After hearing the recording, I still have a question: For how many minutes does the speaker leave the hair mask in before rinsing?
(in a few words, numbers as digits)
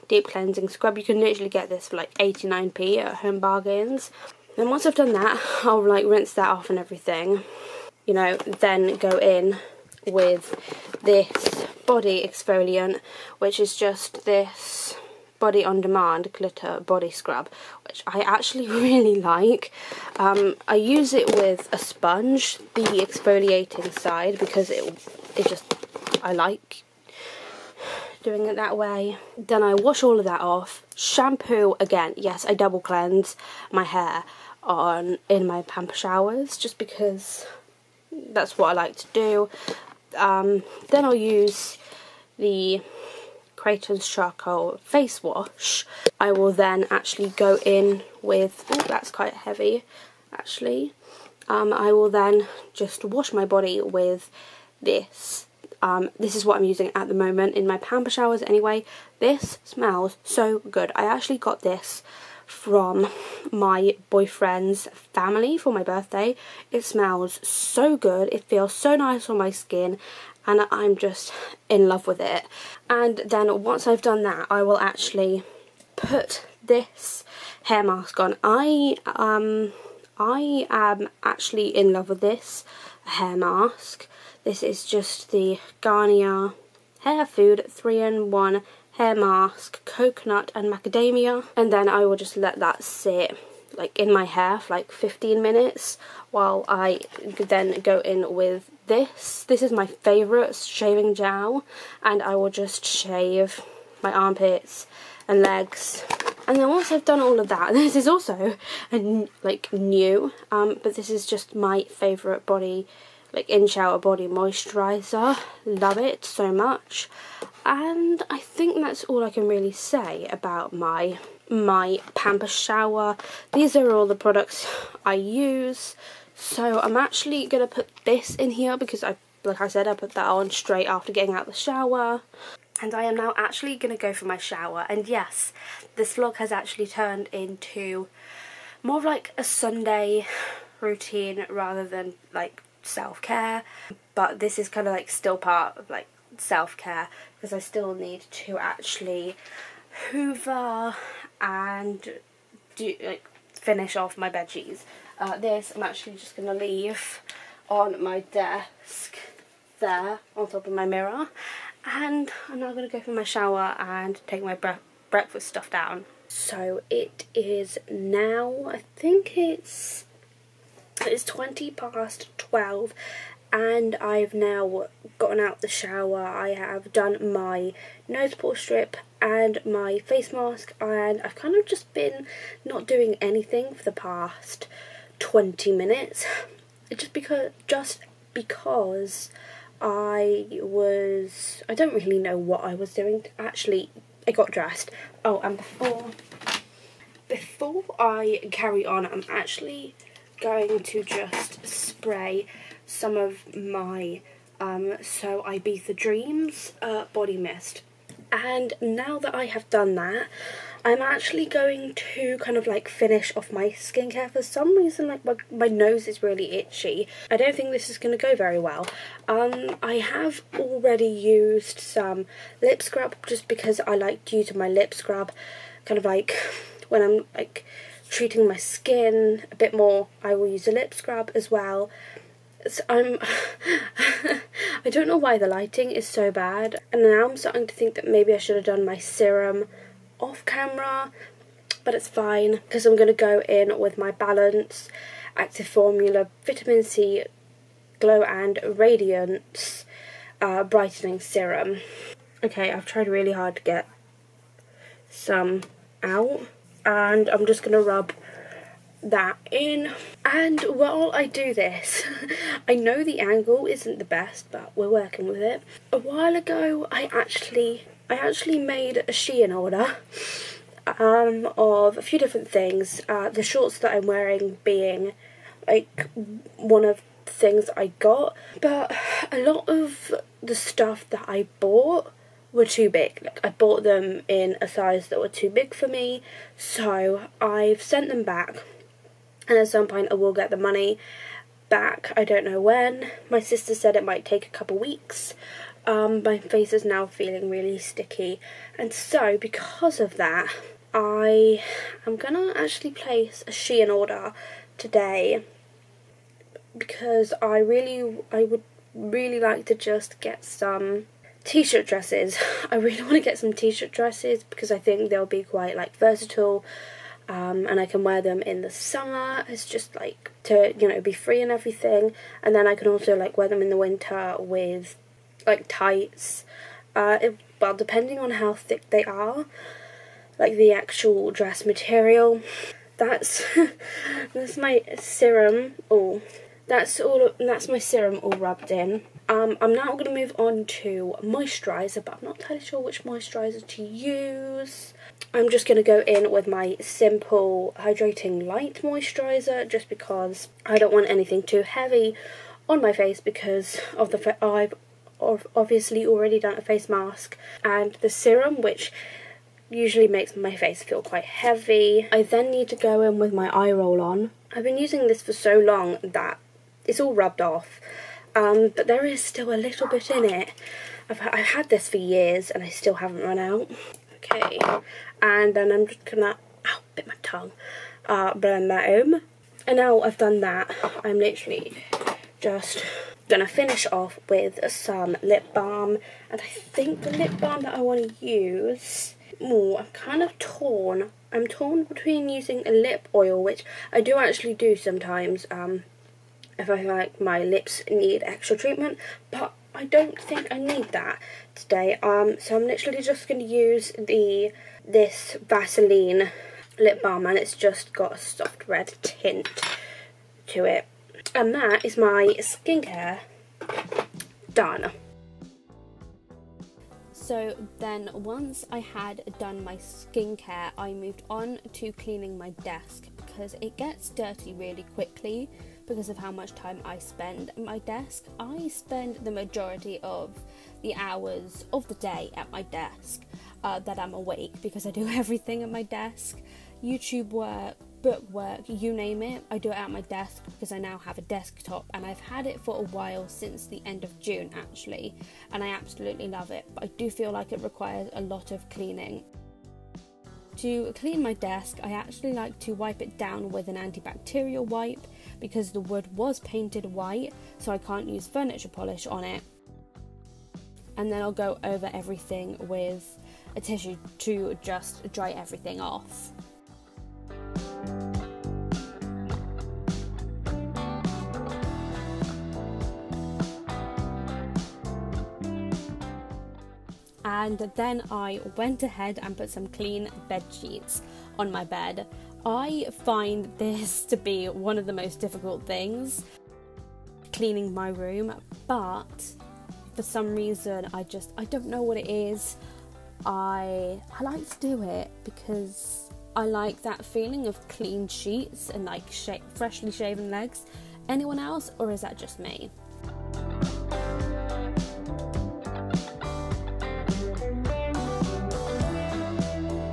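15 minutes.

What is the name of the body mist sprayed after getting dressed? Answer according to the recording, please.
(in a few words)
So Ibiza Dreams.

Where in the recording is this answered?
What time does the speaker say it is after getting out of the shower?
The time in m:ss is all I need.
2:51.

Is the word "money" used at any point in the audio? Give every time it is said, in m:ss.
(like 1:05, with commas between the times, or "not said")
4:50.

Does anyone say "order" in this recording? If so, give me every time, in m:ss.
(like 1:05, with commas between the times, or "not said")
4:29, 5:03.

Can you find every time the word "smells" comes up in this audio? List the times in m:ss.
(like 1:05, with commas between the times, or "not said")
0:59, 1:06.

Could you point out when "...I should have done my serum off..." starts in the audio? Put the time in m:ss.
3:58.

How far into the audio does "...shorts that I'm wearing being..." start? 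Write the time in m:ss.
4:33.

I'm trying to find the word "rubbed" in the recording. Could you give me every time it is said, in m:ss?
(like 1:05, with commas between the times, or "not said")
5:38, 6:07.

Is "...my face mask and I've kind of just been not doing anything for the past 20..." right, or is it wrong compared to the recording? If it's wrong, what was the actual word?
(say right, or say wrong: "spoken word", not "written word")
right.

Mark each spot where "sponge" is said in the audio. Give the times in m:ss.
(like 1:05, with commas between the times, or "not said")
0:21.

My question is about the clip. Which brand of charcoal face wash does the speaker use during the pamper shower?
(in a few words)
Creightons.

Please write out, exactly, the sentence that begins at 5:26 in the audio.
Uh, it, well, depending on how thick they are, like the actual dress material.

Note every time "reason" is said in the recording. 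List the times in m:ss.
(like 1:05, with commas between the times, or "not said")
3:34, 8:10.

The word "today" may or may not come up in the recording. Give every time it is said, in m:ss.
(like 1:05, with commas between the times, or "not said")
5:04, 6:41.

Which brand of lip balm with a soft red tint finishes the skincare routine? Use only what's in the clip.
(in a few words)
Vaseline.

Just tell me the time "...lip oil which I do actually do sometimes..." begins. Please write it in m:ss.
6:32.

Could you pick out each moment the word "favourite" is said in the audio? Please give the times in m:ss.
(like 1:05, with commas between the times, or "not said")
1:39, 1:51.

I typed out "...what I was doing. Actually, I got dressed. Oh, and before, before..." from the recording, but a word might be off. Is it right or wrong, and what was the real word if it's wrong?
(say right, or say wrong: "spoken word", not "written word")
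right.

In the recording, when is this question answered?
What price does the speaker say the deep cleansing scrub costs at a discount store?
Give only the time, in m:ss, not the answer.
0:02.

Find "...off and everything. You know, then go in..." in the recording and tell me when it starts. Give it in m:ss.
0:06.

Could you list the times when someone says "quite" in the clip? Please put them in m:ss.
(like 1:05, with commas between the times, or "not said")
0:49, 5:15, 6:01.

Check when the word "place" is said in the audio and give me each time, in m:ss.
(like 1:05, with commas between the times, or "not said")
5:02.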